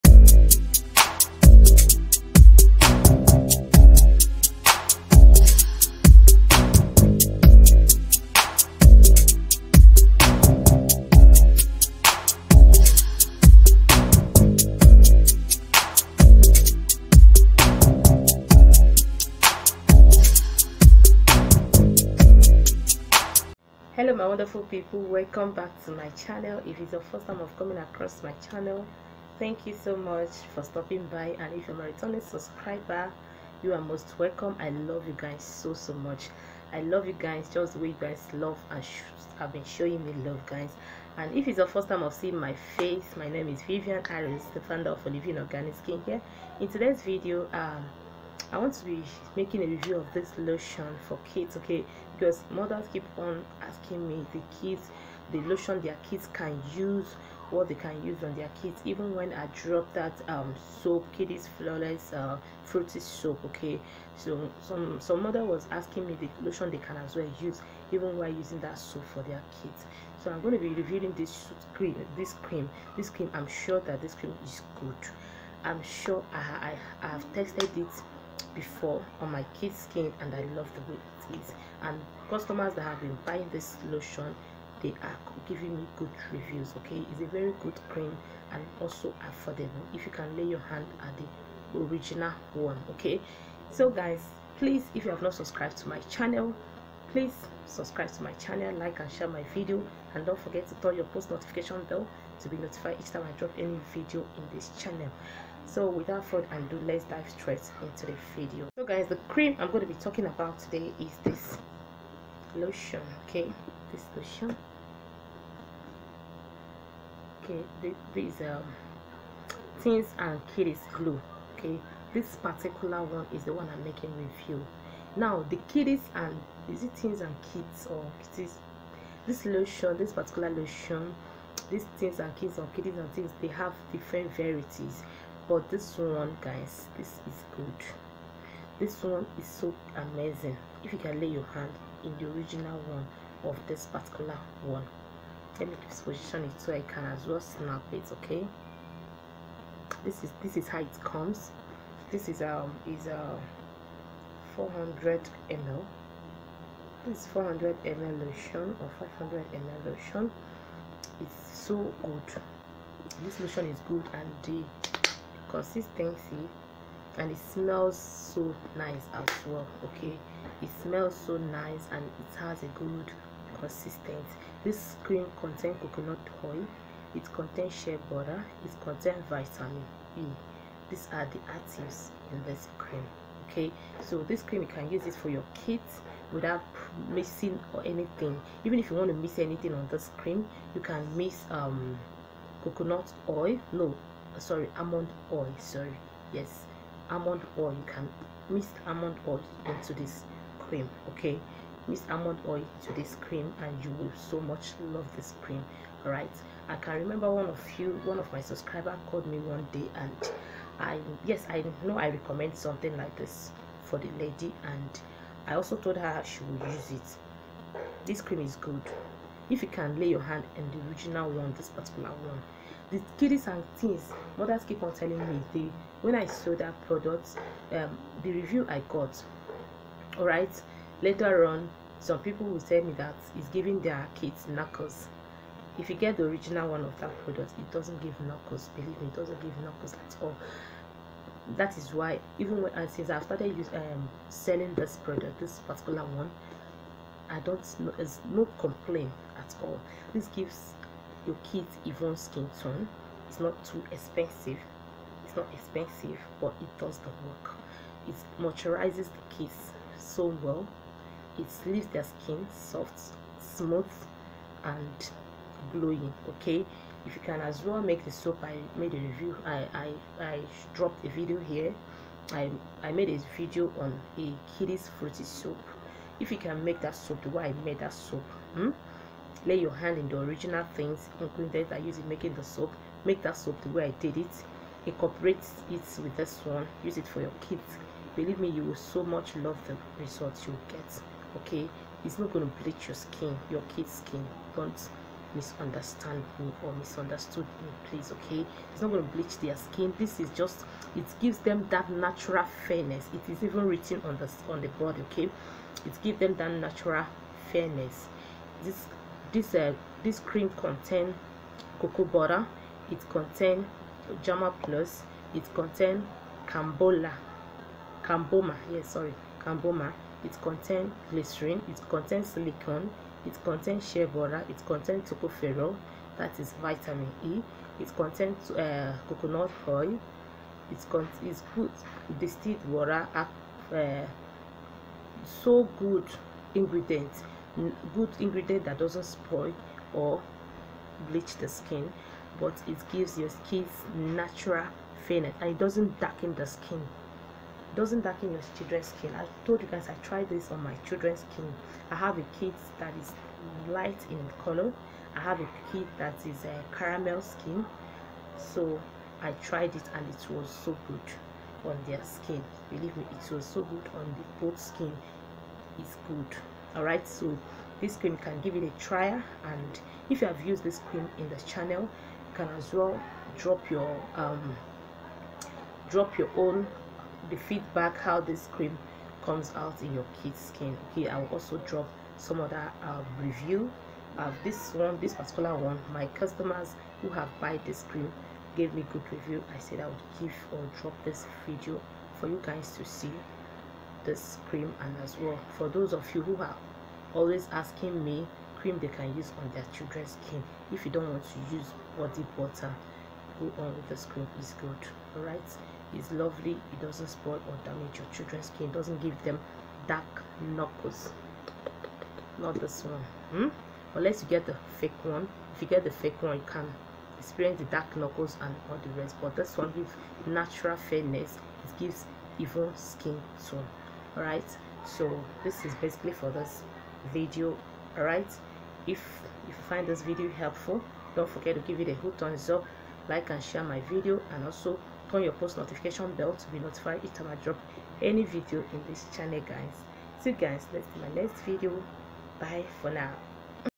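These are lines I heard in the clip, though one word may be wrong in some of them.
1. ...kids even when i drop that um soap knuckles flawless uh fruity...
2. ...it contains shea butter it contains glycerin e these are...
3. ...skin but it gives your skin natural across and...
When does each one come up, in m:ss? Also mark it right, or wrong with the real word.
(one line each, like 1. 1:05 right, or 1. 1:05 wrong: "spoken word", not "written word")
1. 0:58 wrong: "kiddies", not "knuckles"
2. 2:57 wrong: "vitamin", not "glycerin"
3. 5:41 wrong: "fairness", not "across".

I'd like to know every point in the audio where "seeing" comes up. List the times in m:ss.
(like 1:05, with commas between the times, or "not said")
0:42.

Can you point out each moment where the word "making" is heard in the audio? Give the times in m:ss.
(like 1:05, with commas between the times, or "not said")
0:49, 2:03, 4:42.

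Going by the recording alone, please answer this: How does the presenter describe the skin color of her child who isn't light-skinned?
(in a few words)
Caramel.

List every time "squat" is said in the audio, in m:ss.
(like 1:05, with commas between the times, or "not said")
not said.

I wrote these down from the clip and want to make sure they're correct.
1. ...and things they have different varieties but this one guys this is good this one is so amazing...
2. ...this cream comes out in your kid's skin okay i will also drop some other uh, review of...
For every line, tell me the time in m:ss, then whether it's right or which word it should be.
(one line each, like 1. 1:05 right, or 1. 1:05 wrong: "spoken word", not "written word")
1. 2:12 right
2. 6:18 right.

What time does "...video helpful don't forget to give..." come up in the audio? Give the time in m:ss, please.
7:10.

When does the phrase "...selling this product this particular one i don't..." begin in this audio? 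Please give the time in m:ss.
4:04.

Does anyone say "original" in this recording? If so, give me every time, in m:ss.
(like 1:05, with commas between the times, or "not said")
1:31, 2:22, 3:40, 3:56, 4:40.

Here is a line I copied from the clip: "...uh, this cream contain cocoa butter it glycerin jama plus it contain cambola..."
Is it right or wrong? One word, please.
wrong.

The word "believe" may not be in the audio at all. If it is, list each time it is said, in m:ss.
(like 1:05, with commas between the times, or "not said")
3:58, 4:48, 6:02.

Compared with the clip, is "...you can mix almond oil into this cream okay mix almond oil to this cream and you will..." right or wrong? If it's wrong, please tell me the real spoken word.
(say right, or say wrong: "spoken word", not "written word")
right.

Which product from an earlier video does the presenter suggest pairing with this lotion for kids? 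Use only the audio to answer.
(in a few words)
Kiddies fruity soap.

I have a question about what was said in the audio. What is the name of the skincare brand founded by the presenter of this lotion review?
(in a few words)
Olyveen Organic Skin.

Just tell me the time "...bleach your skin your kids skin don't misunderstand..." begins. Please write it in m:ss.
4:52.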